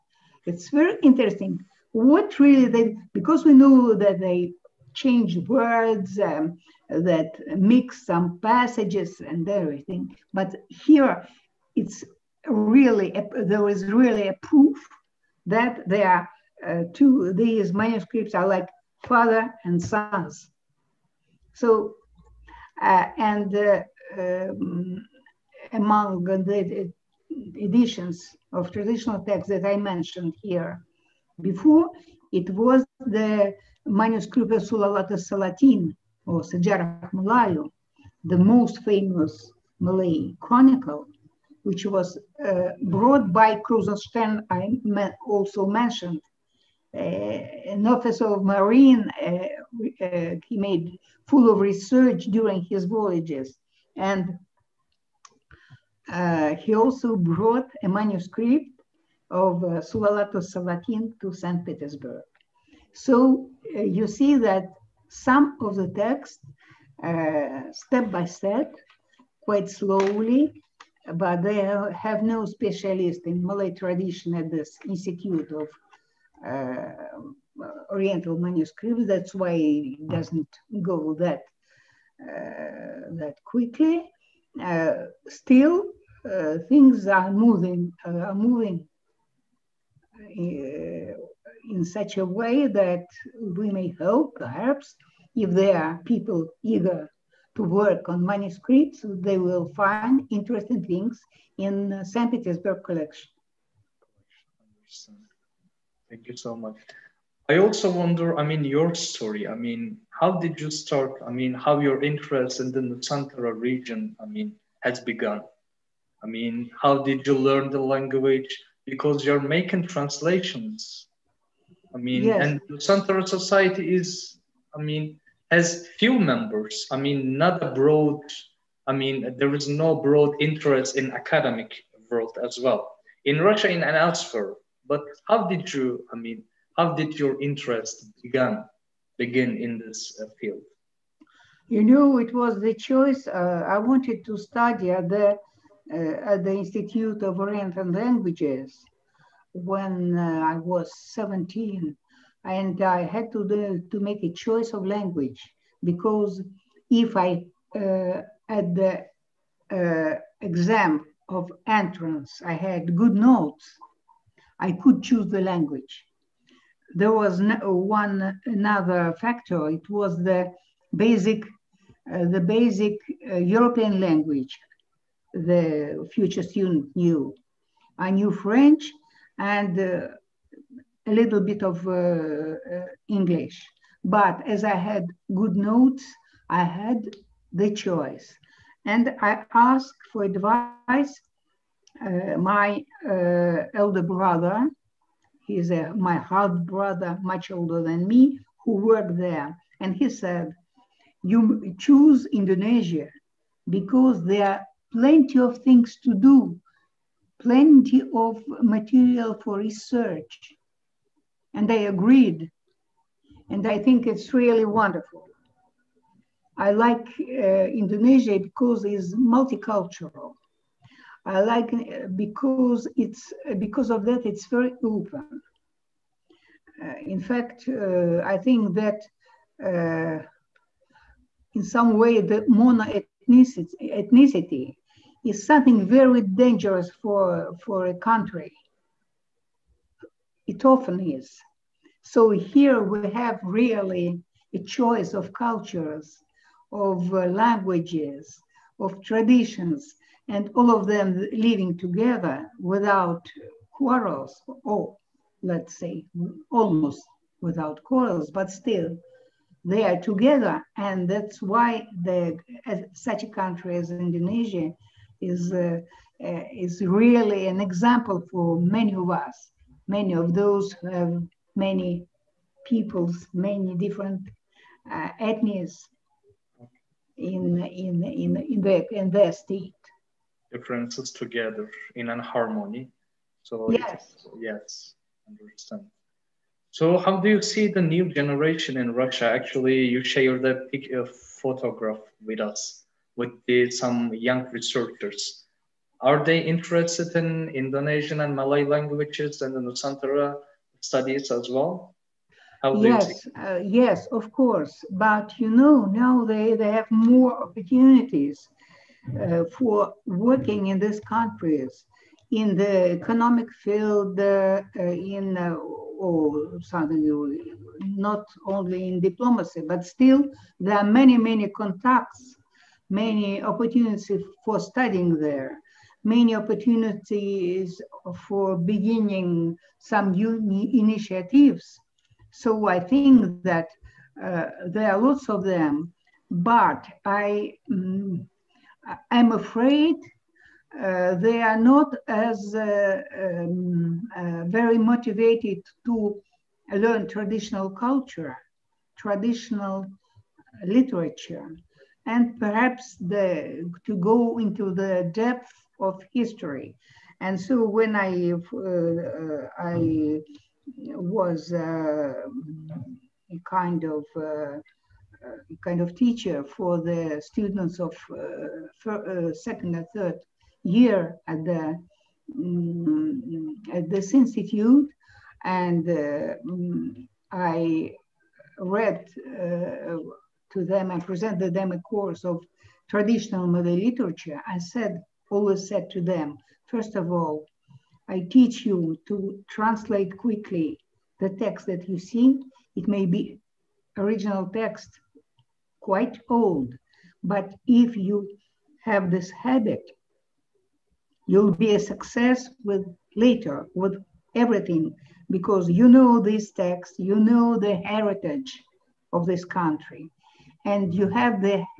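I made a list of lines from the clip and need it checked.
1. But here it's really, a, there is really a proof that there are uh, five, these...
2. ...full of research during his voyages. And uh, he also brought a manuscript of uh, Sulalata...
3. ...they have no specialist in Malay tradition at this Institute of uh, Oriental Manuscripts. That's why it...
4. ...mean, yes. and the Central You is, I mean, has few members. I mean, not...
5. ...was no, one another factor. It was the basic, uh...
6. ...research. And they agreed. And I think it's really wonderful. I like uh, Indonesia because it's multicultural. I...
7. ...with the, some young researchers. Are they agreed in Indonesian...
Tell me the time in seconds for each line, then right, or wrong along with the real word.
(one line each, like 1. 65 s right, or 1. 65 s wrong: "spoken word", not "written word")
1. 10 s wrong: "two", not "five"
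2. 51 s right
3. 71 s right
4. 121 s wrong: "Society", not "You"
5. 167 s right
6. 209 s right
7. 293 s wrong: "interested", not "agreed".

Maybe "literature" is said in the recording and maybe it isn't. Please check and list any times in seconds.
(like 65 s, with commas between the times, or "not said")
350 s, 383 s.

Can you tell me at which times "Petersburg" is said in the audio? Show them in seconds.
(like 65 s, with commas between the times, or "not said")
61 s, 102 s.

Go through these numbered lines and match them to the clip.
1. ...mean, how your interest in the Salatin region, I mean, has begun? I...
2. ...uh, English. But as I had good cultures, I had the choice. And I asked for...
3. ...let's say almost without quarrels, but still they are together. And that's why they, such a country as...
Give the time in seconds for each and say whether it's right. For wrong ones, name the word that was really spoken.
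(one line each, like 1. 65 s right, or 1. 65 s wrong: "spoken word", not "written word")
1. 111 s wrong: "Nusantara", not "Salatin"
2. 181 s wrong: "notes", not "cultures"
3. 255 s right.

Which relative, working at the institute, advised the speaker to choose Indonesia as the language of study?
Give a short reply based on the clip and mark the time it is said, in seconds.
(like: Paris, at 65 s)
elder brother, at 193 s.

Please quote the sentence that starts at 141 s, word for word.
You know, it was the choice.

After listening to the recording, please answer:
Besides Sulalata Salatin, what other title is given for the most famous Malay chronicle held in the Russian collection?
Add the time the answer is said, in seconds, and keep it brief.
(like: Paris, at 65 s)
Sejarah Malayu, at 36 s.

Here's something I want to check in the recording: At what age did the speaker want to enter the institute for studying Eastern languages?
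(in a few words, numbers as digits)
17.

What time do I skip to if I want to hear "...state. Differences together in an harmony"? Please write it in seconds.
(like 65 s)
279 s.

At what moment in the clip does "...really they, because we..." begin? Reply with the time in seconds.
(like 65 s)
2 s.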